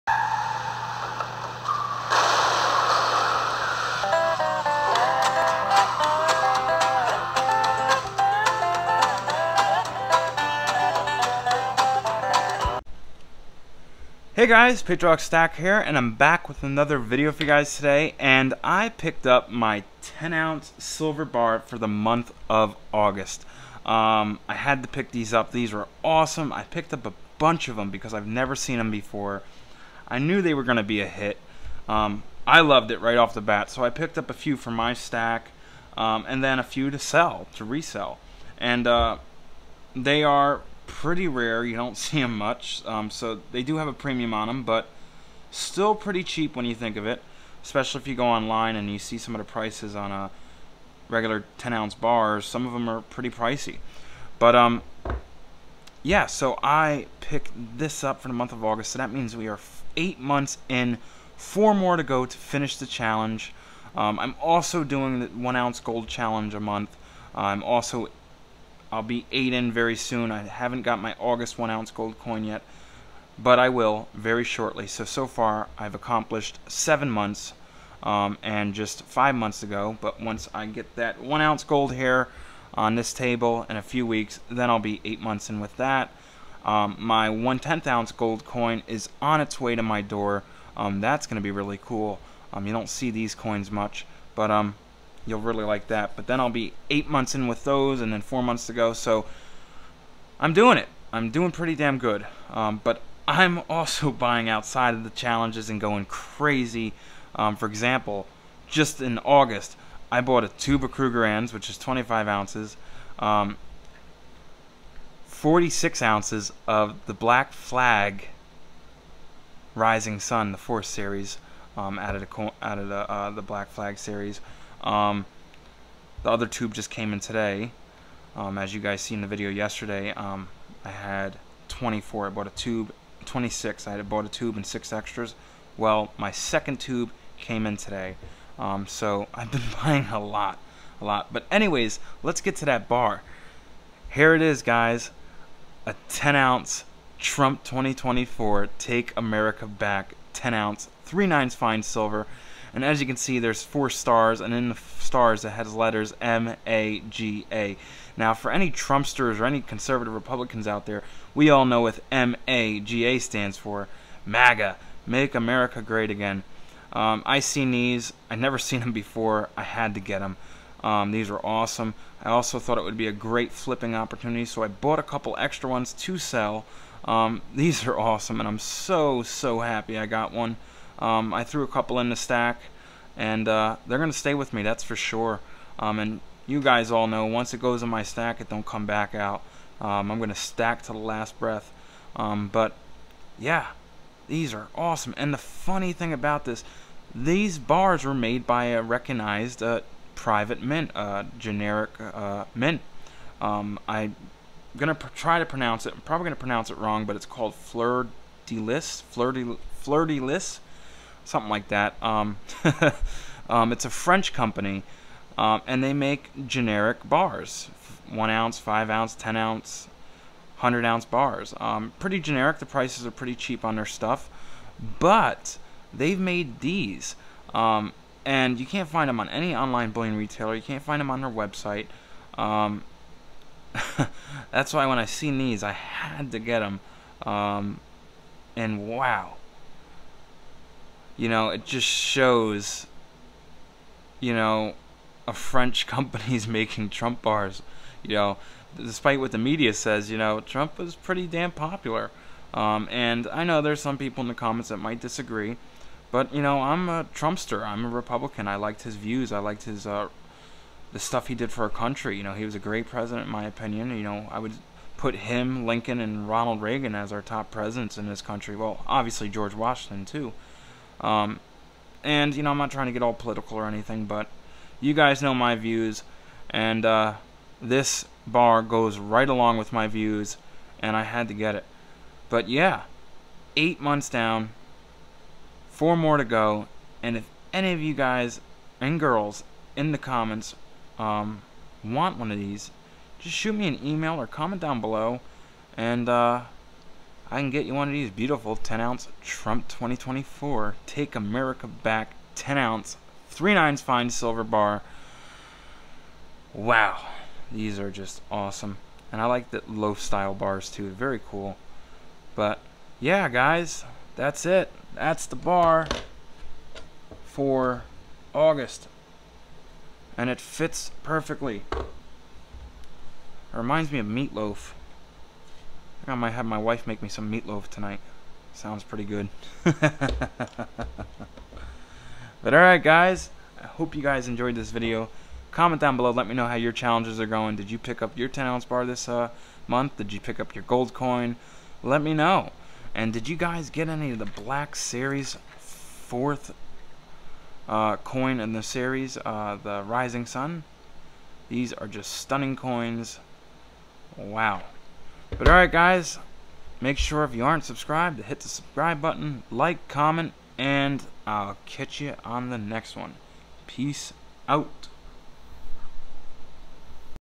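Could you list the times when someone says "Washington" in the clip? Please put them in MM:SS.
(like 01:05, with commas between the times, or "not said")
04:29.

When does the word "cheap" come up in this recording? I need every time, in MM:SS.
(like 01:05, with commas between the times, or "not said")
00:46, 03:43.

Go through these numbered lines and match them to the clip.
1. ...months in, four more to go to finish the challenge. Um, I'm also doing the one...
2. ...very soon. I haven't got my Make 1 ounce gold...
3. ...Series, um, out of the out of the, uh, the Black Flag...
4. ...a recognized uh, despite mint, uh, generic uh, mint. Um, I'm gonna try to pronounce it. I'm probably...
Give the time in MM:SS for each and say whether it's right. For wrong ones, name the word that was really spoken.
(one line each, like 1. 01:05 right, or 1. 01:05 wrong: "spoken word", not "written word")
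1. 01:00 right
2. 01:09 wrong: "August", not "Make"
3. 02:00 right
4. 03:18 wrong: "private", not "despite".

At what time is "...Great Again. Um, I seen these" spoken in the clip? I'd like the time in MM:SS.
02:45.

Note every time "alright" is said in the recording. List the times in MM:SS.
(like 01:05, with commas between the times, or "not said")
05:32, 05:55.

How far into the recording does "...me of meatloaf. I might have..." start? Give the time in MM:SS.
05:23.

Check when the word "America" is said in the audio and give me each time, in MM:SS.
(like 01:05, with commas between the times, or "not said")
02:29, 02:45, 05:01.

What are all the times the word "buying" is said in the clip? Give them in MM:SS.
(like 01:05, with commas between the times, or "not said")
01:44, 02:19.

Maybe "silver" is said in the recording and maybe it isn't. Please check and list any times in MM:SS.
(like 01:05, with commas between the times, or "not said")
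00:20, 02:31, 05:04.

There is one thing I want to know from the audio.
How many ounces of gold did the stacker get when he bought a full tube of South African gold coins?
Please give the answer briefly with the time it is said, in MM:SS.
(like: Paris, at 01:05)
25, at 01:51.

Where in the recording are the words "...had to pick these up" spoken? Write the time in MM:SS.
00:24.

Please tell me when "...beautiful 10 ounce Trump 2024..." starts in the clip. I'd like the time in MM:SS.
04:58.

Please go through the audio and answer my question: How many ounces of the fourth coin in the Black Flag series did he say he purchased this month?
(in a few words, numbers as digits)
46.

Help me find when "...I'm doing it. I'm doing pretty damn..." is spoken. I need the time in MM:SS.
01:40.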